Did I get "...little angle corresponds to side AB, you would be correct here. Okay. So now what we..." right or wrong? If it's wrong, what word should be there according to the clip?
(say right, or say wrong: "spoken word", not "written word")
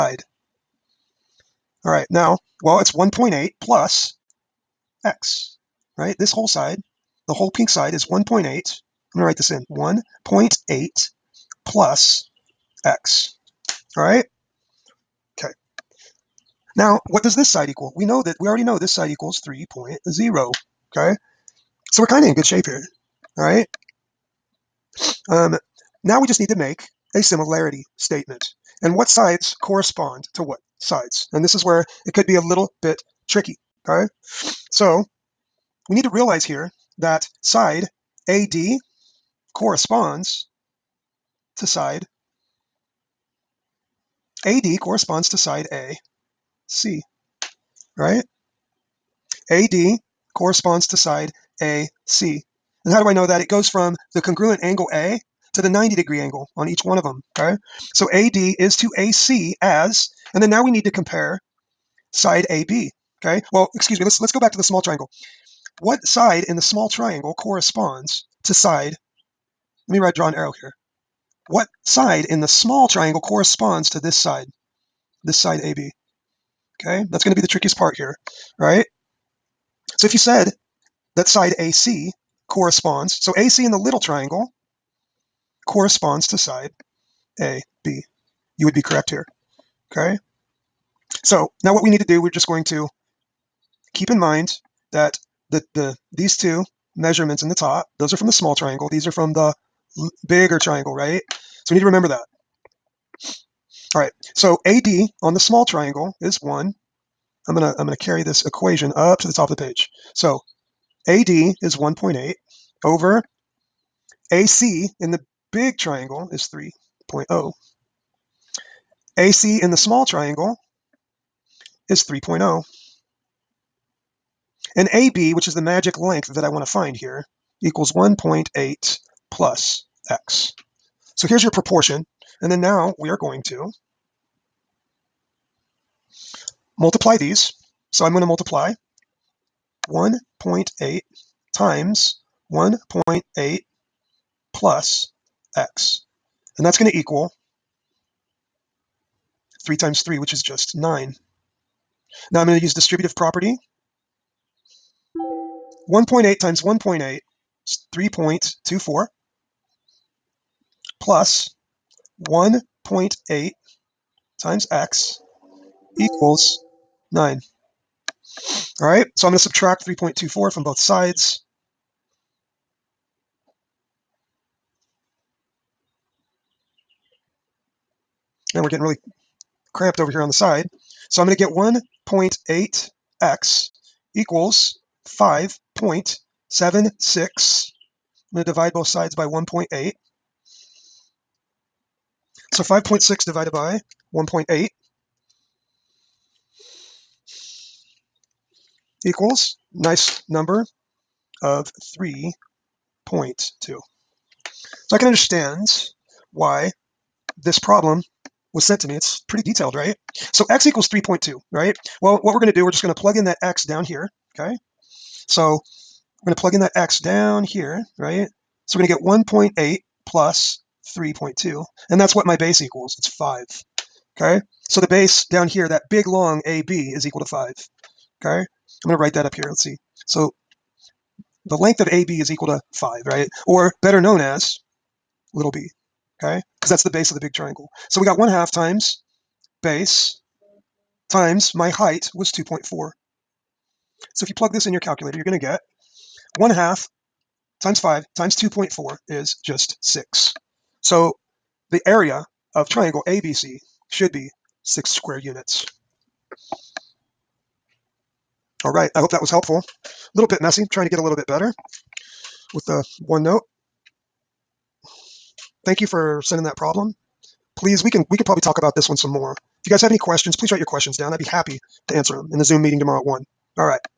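wrong: "triangle", not "angle".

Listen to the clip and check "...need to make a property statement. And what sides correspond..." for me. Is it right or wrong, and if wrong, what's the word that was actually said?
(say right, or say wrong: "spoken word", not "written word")
wrong: "similarity", not "property".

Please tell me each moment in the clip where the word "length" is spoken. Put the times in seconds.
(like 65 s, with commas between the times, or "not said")
125 s, 231 s.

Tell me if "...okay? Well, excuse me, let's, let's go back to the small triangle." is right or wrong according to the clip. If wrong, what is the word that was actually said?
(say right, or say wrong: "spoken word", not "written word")
right.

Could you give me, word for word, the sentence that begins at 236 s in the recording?
Because that's the base of the big triangle.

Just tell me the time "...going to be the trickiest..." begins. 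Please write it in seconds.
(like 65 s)
77 s.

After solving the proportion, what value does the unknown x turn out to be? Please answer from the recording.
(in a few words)
3.2.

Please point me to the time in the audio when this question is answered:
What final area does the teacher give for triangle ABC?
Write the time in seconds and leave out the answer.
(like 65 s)
254 s.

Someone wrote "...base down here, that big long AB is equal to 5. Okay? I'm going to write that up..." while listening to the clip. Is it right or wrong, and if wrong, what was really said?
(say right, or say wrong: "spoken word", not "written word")
right.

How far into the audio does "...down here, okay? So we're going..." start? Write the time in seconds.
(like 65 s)
213 s.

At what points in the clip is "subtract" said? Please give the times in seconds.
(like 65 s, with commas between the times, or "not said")
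169 s.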